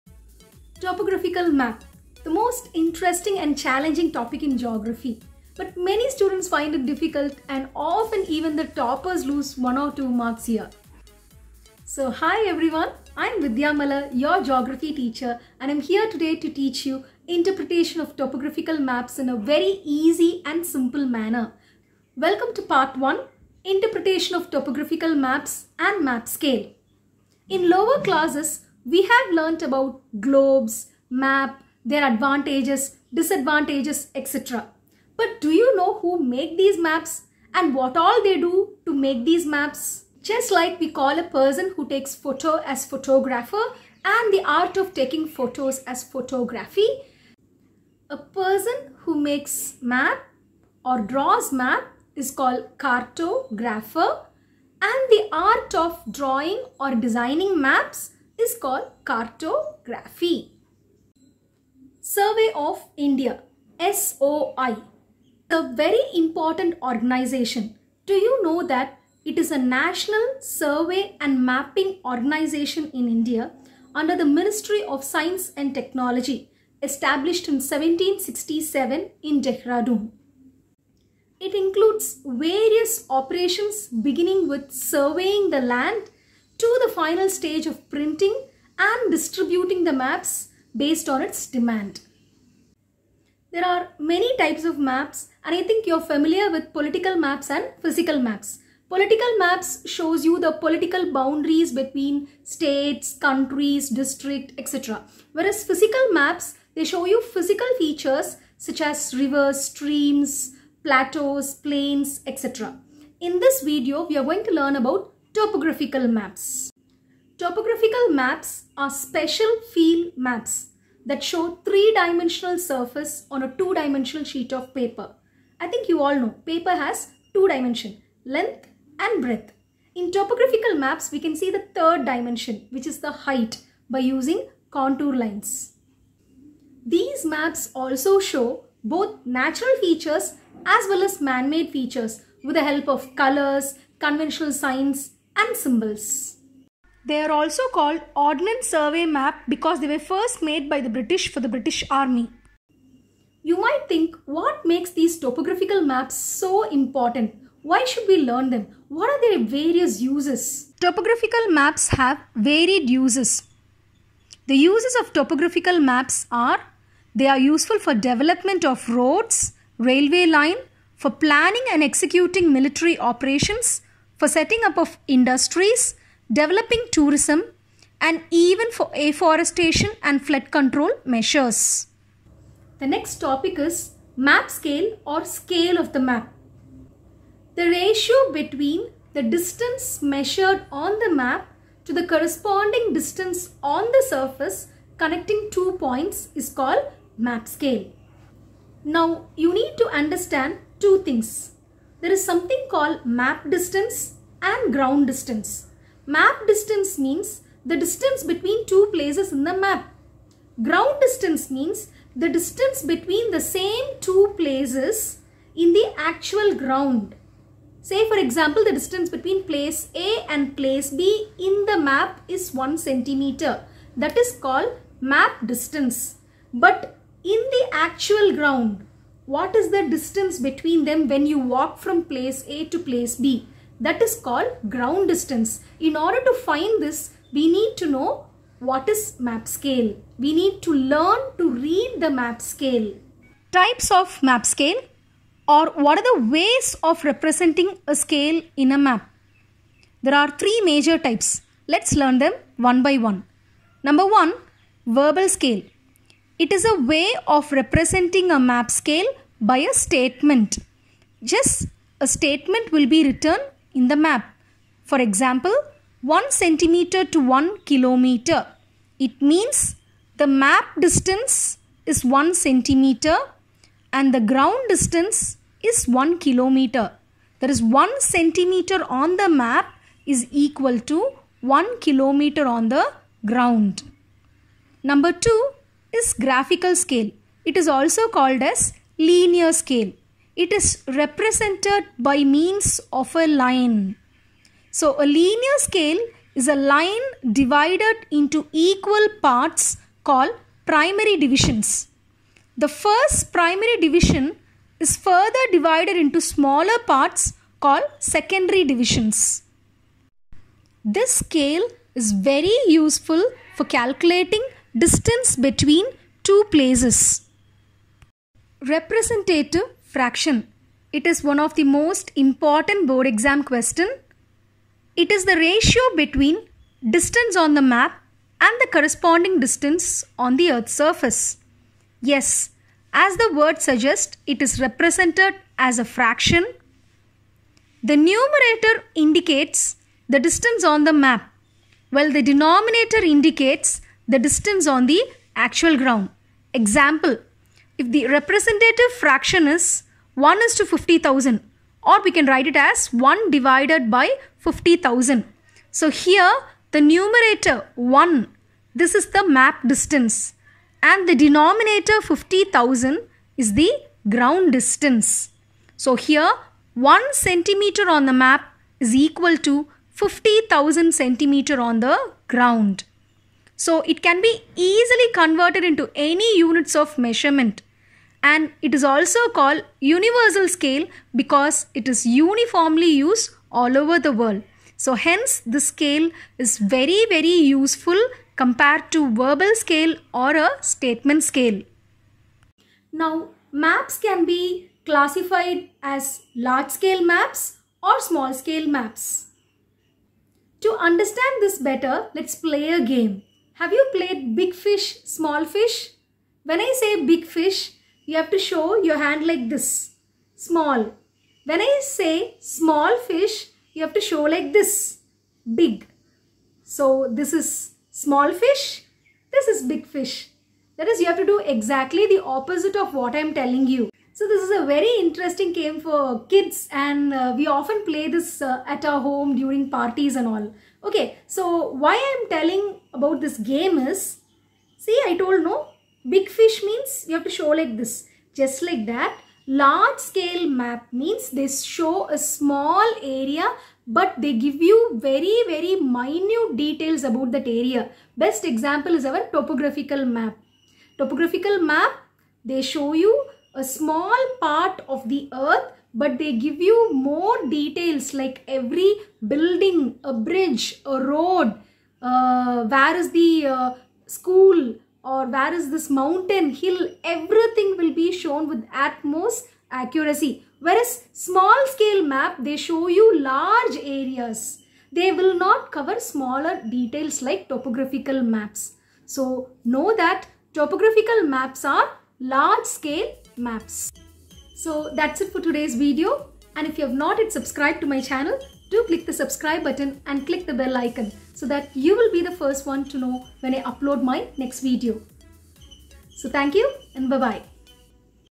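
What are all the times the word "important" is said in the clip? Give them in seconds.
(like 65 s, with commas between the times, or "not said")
66 s, 156 s, 322 s.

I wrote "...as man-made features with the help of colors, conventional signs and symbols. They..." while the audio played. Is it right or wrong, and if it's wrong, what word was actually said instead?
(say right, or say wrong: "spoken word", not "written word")
right.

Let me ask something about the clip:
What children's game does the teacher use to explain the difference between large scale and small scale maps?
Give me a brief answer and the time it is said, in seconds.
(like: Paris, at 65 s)
big fish, small fish, at 404 s.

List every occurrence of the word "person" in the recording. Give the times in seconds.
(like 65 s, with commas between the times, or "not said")
41 s, 48 s.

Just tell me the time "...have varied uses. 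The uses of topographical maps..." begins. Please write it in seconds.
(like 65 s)
161 s.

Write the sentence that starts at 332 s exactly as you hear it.
Yes, as the word suggests, it is represented as a fraction.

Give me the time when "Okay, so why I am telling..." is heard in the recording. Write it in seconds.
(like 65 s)
430 s.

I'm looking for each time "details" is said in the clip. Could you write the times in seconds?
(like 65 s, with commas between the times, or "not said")
446 s, 457 s, 476 s.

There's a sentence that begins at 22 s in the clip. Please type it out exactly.
Welcome to part 1, Interpretation of Topographical Maps and Map Scale.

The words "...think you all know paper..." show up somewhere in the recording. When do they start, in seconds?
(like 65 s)
125 s.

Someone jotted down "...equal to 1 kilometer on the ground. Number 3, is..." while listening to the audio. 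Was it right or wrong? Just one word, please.
wrong.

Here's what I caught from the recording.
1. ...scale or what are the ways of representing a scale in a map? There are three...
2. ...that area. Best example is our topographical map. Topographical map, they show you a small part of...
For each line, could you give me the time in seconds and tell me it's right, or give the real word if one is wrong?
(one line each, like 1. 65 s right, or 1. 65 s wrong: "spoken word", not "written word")
1. 244 s right
2. 447 s right.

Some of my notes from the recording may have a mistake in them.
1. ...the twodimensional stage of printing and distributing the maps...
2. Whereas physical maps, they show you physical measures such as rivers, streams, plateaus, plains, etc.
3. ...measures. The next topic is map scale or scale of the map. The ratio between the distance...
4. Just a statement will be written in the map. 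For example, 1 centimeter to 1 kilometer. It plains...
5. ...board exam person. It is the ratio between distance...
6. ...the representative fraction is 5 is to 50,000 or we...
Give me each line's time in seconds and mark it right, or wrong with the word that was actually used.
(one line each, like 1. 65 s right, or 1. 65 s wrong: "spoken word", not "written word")
1. 86 s wrong: "final", not "twodimensional"
2. 105 s wrong: "features", not "measures"
3. 181 s right
4. 261 s wrong: "means", not "plains"
5. 322 s wrong: "question", not "person"
6. 347 s wrong: "1", not "5".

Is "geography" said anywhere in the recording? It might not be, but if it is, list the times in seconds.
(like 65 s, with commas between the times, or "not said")
4 s, 14 s.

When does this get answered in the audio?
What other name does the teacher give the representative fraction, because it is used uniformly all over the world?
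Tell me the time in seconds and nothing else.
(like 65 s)
379 s.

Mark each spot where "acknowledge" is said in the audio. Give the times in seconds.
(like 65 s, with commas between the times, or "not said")
not said.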